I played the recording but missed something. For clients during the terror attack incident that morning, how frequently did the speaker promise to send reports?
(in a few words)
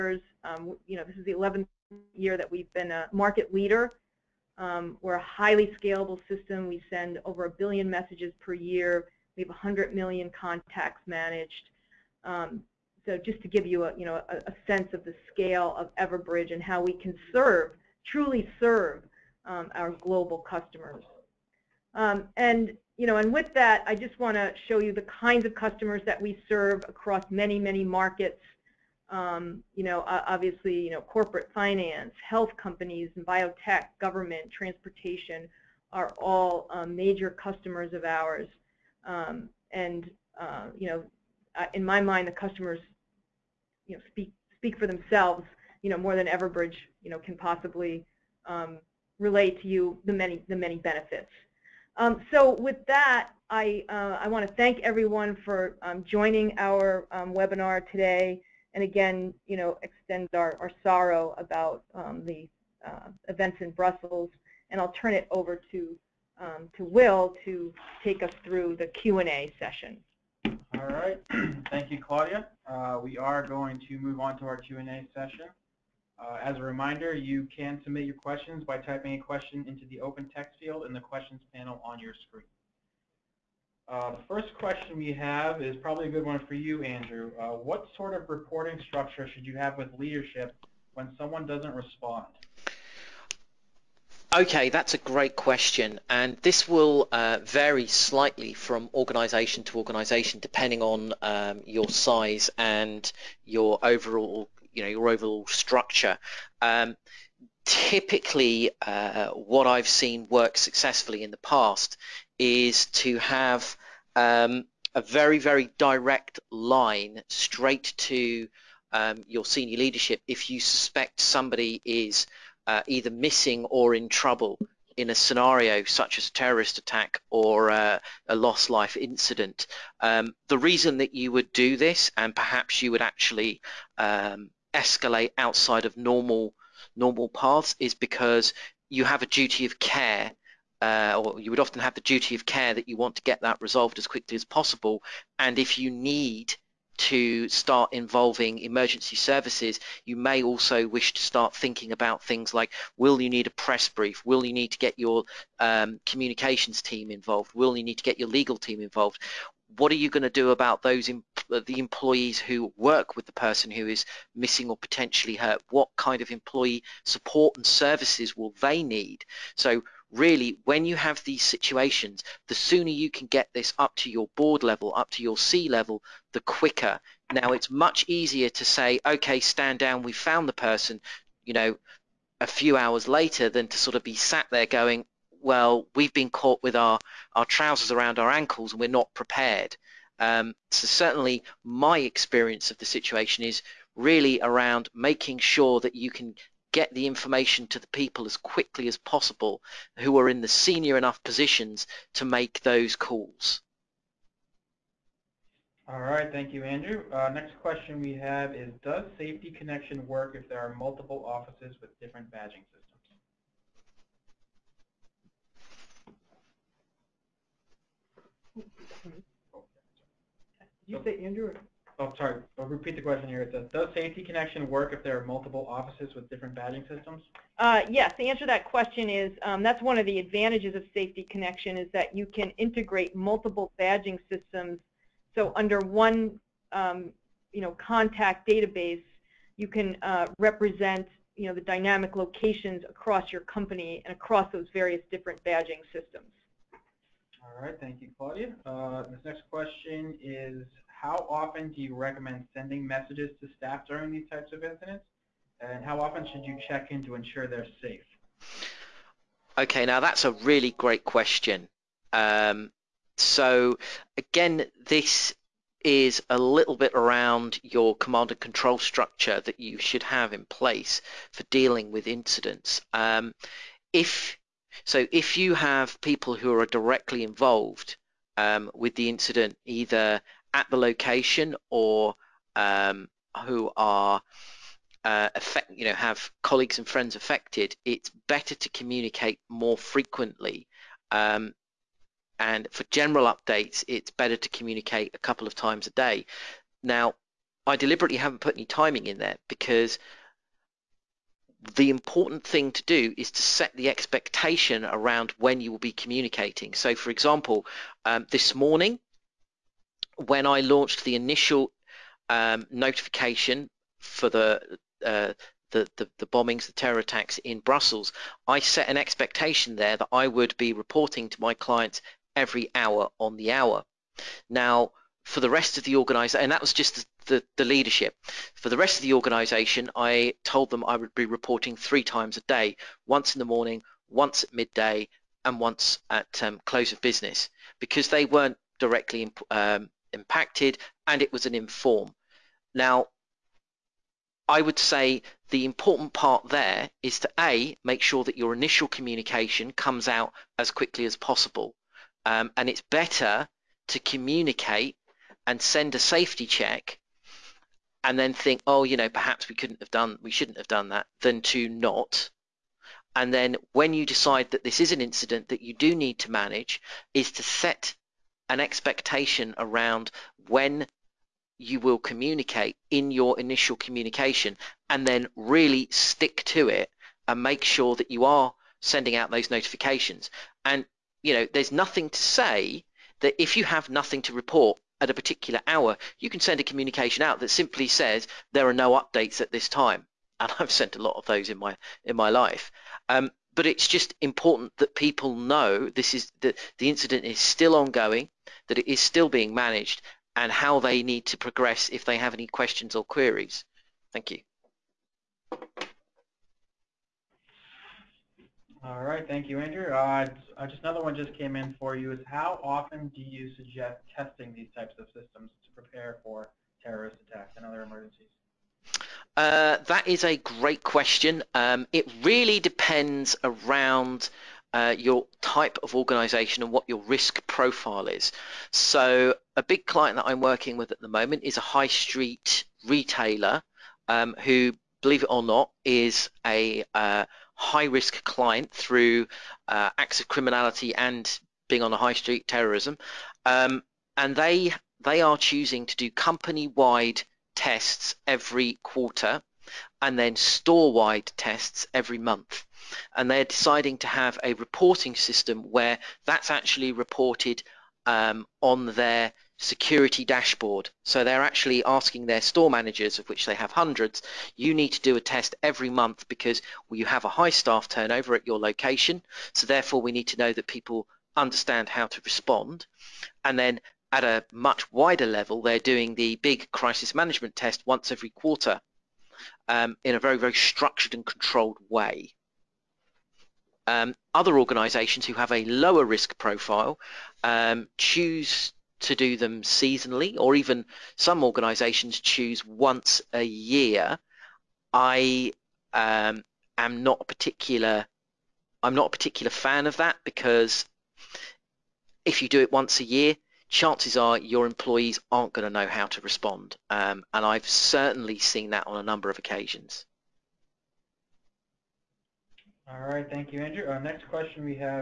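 every hour.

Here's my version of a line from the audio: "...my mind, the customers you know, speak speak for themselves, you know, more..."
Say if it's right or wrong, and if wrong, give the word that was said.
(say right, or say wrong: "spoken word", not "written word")
right.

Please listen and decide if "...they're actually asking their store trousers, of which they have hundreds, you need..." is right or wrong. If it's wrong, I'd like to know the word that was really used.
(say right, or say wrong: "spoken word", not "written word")
wrong: "managers", not "trousers".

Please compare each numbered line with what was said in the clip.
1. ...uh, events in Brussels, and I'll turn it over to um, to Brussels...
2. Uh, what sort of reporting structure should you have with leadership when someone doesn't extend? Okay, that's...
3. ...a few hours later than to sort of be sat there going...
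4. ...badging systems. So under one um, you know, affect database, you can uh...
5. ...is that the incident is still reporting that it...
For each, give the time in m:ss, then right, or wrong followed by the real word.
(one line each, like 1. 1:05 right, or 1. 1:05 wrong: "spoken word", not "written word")
1. 1:02 wrong: "Will", not "Brussels"
2. 1:27 wrong: "respond", not "extend"
3. 3:02 right
4. 3:53 wrong: "contact", not "affect"
5. 6:36 wrong: "ongoing", not "reporting".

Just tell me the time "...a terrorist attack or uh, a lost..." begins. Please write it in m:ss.
2:06.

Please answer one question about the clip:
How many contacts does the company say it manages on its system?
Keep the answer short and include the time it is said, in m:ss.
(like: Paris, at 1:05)
100 million, at 0:09.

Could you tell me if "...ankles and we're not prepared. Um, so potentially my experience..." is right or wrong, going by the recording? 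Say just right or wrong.
wrong.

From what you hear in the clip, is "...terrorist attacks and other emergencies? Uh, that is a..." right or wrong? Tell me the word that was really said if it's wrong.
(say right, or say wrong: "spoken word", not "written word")
right.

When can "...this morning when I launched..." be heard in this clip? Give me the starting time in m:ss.
5:08.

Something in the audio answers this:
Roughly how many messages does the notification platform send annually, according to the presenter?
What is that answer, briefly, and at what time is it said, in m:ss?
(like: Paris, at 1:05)
over a billion, at 0:07.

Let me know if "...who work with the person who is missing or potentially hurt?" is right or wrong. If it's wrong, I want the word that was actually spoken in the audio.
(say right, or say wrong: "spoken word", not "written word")
right.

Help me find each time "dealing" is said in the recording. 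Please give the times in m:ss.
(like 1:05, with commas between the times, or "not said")
4:31.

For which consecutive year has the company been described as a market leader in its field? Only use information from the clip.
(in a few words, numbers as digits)
11th.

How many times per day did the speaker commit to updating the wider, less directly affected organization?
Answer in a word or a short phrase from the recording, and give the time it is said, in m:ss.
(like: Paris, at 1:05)
3, at 5:31.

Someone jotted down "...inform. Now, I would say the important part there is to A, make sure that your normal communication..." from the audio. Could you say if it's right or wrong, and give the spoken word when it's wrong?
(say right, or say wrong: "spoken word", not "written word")
wrong: "initial", not "normal".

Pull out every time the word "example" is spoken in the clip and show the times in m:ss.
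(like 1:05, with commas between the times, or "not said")
5:07.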